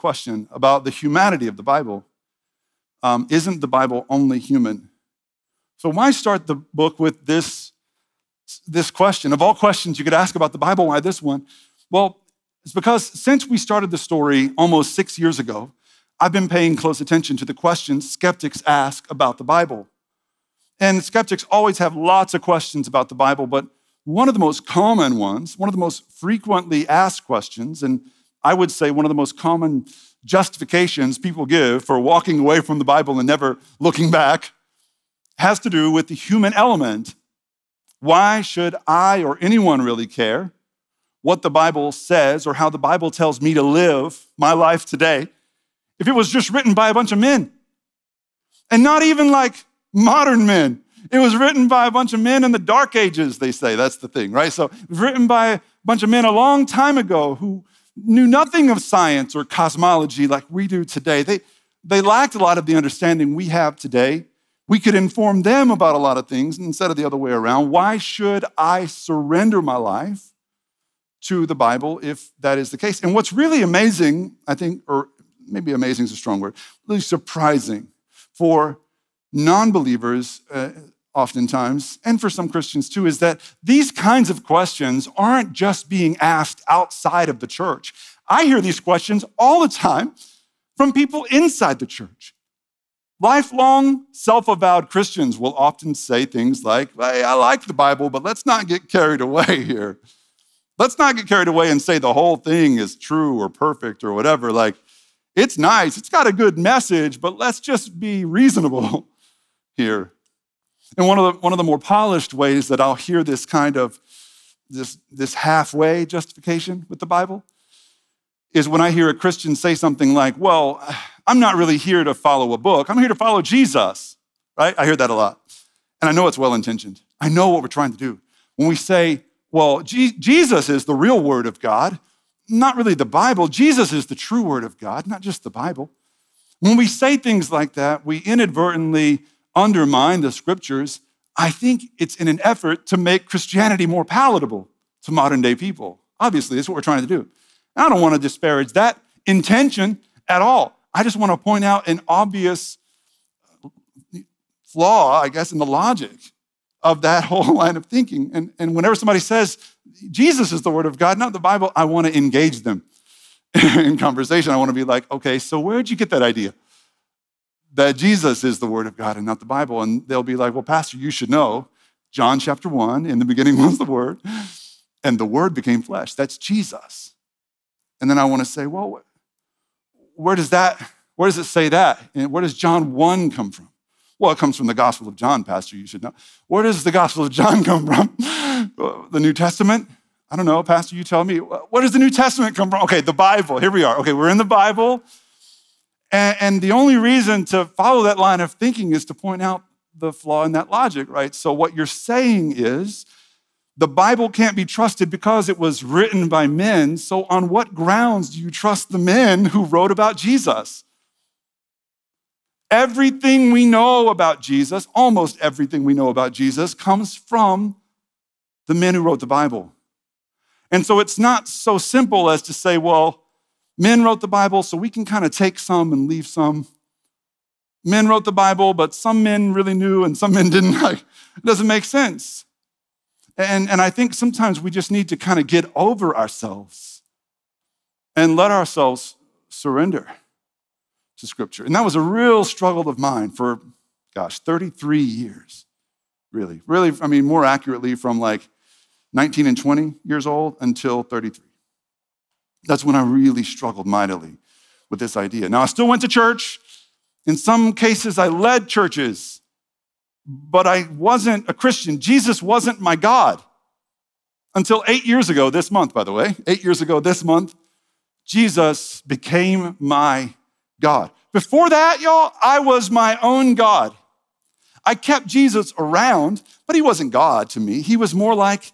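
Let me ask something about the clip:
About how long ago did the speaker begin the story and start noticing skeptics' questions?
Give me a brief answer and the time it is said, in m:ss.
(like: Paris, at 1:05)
almost 6 years, at 0:14.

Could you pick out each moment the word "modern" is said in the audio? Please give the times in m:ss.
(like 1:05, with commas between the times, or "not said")
0:49, 2:25.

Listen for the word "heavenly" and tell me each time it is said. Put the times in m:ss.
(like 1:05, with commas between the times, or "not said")
not said.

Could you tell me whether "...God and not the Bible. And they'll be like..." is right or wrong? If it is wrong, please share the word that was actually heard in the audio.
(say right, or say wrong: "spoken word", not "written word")
right.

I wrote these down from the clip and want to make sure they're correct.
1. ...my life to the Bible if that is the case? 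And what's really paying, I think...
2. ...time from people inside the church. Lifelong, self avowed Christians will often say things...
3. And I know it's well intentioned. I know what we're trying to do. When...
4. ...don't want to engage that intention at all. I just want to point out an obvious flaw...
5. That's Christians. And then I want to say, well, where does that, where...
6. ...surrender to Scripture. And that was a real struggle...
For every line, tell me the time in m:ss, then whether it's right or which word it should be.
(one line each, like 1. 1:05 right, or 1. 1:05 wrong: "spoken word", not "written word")
1. 1:09 wrong: "amazing", not "paying"
2. 1:29 right
3. 2:06 right
4. 2:27 wrong: "disparage", not "engage"
5. 2:56 wrong: "Jesus", not "Christians"
6. 3:59 right.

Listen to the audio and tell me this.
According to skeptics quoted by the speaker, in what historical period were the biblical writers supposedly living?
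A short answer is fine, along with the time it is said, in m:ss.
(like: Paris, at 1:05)
the dark ages, at 0:52.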